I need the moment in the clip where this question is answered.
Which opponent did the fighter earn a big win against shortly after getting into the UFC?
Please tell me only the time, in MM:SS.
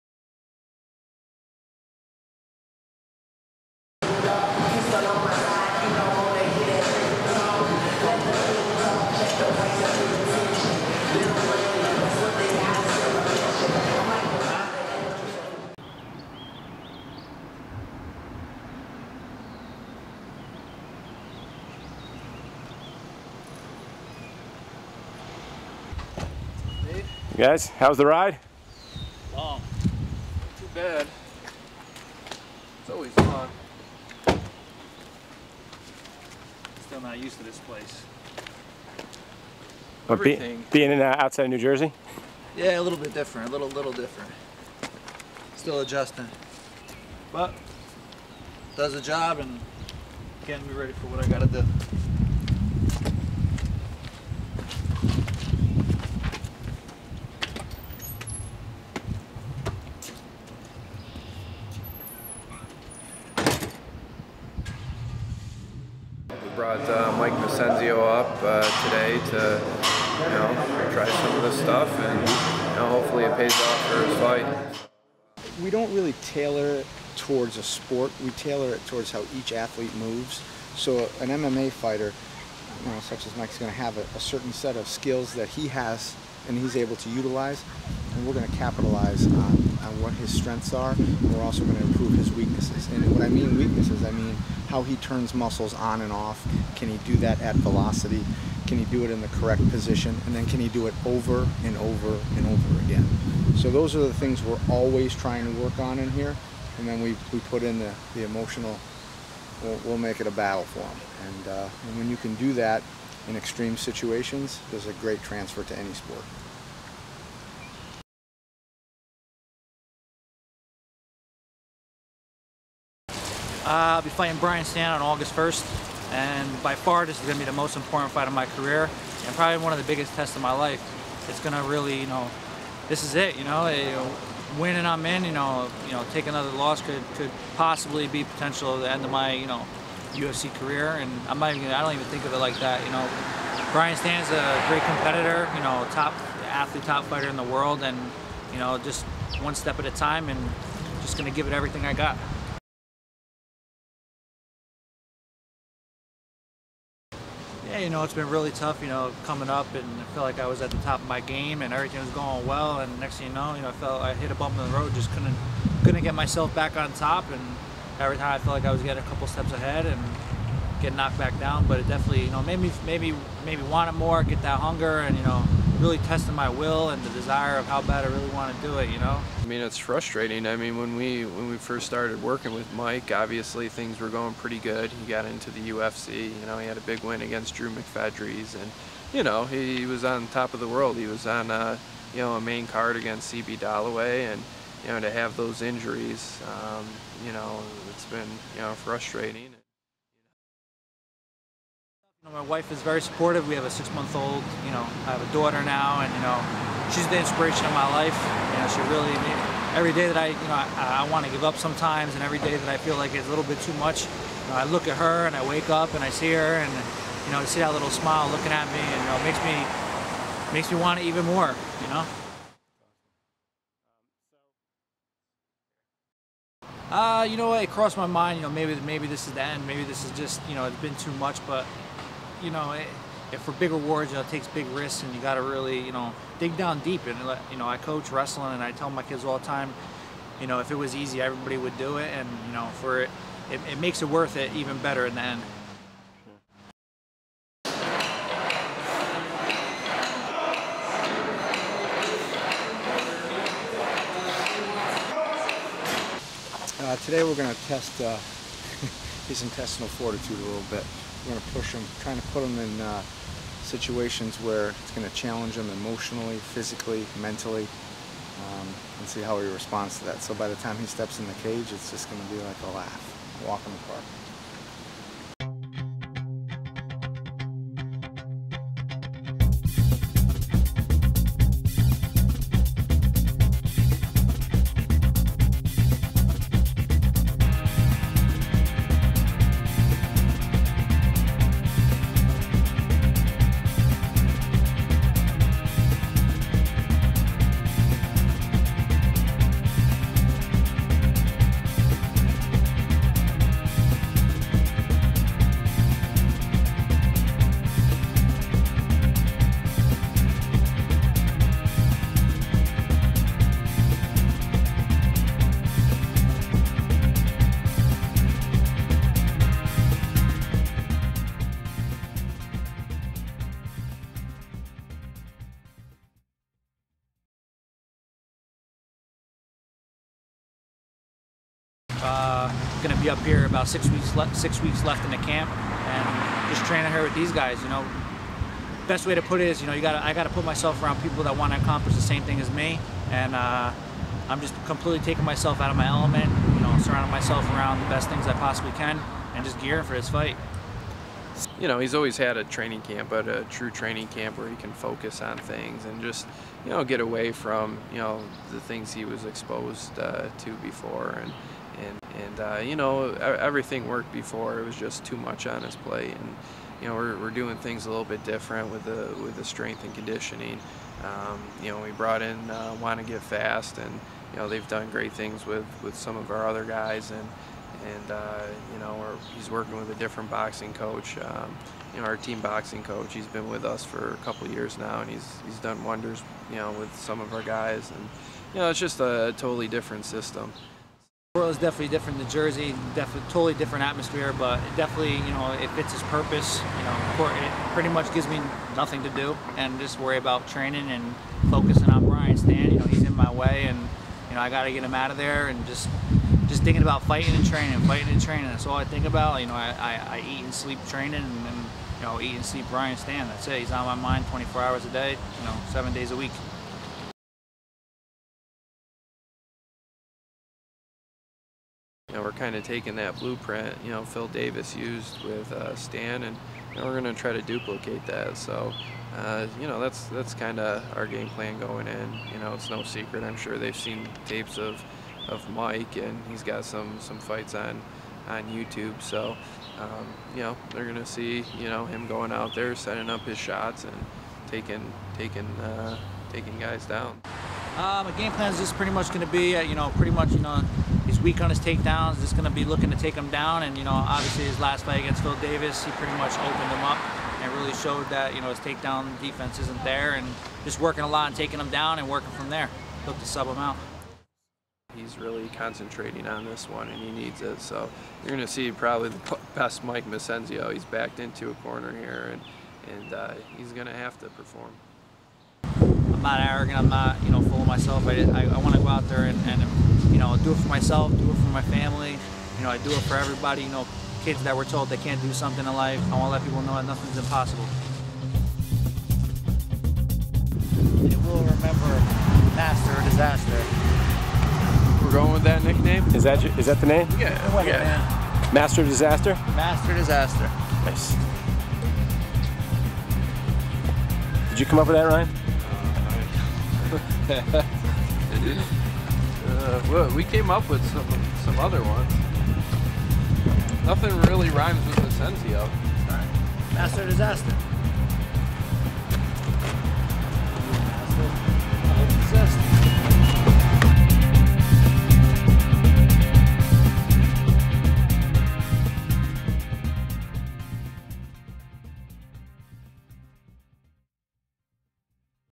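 03:07.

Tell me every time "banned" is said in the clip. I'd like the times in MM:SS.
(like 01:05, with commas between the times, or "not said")
not said.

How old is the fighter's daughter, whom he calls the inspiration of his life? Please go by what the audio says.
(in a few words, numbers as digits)
6 months.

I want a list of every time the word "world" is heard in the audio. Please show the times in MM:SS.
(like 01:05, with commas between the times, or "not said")
02:27, 03:10, 06:31.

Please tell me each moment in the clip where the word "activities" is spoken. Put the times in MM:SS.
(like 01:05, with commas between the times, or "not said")
not said.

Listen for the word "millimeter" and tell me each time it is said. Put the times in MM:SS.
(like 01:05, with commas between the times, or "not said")
not said.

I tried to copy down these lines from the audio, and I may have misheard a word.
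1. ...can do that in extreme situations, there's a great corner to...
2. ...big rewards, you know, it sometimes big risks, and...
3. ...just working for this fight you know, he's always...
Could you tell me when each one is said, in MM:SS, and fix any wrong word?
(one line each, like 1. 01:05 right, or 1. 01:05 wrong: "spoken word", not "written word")
1. 01:52 wrong: "transfer", not "corner"
2. 03:53 wrong: "takes", not "sometimes"
3. 05:49 wrong: "gearing", not "working".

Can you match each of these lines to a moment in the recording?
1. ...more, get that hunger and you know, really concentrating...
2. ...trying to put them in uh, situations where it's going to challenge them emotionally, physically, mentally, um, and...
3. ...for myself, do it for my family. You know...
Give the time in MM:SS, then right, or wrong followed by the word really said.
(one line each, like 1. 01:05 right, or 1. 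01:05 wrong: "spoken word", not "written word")
1. 02:53 wrong: "testing", not "concentrating"
2. 04:22 right
3. 08:00 right.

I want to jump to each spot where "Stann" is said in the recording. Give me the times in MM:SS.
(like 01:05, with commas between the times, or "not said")
02:04, 02:23, 06:42, 06:52, 07:05.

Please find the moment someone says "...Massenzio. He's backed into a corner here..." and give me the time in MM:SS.
07:50.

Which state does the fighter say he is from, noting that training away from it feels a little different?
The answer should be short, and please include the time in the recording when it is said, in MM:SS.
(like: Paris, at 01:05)
New Jersey, at 00:41.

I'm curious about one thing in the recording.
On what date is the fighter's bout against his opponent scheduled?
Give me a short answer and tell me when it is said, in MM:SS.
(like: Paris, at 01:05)
August 1st, at 02:05.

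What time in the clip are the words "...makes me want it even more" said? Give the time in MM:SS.
03:40.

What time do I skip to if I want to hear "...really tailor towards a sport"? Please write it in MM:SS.
01:15.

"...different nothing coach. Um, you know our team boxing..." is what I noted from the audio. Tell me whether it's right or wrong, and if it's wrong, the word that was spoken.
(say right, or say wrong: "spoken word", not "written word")
wrong: "boxing", not "nothing".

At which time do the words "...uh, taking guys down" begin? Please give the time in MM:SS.
07:25.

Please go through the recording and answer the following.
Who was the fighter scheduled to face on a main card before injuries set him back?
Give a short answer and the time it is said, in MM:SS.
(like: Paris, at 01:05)
CB Dolloway, at 03:13.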